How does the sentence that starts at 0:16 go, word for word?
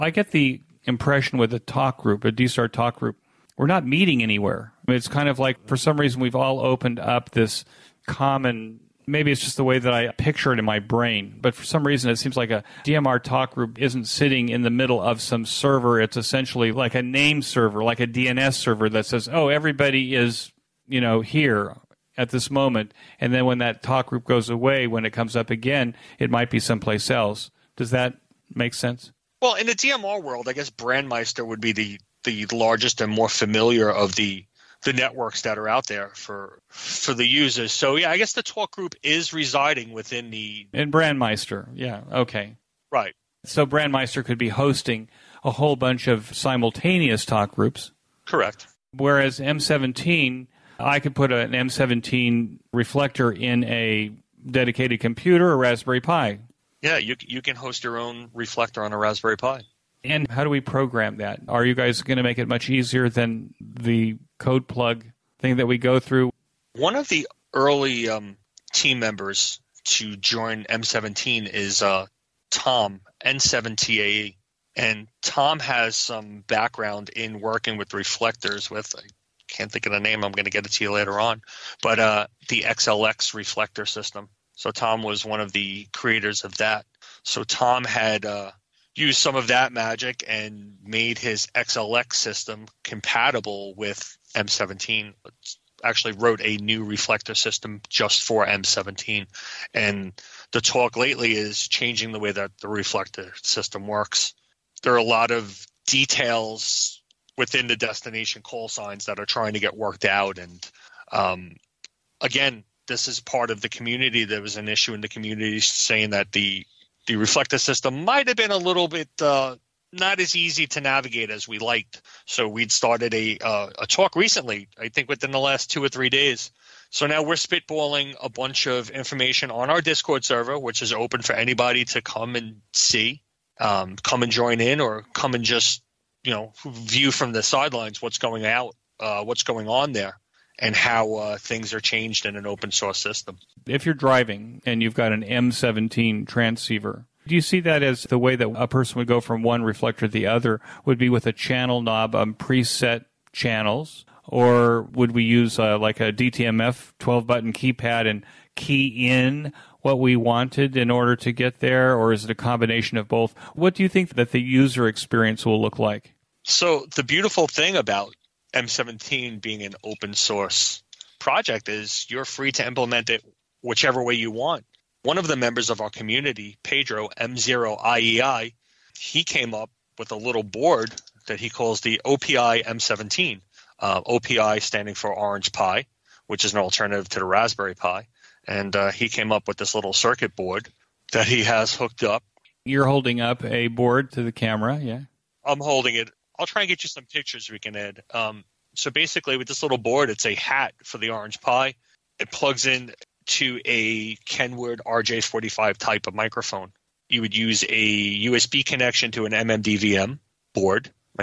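It's essentially like a name server, like a DNS server that says, "Oh, everybody is you know here." at this moment.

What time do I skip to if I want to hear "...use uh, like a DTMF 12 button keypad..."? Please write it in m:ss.
2:35.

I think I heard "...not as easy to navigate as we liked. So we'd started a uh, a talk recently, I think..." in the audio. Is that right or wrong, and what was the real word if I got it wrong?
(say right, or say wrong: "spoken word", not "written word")
right.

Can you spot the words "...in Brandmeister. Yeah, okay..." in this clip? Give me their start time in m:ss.
0:40.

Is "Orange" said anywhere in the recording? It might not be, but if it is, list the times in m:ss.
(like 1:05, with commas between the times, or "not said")
3:05, 3:21.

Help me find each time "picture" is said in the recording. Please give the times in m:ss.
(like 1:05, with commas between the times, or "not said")
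0:10, 3:17.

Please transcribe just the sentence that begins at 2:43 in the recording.
What do you think that the user experience will look like?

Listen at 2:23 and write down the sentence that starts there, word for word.
If you're driving and you've got an M17 transceiver.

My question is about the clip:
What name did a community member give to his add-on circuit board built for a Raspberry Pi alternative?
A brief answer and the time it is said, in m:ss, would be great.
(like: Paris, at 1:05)
OPI M17, at 3:02.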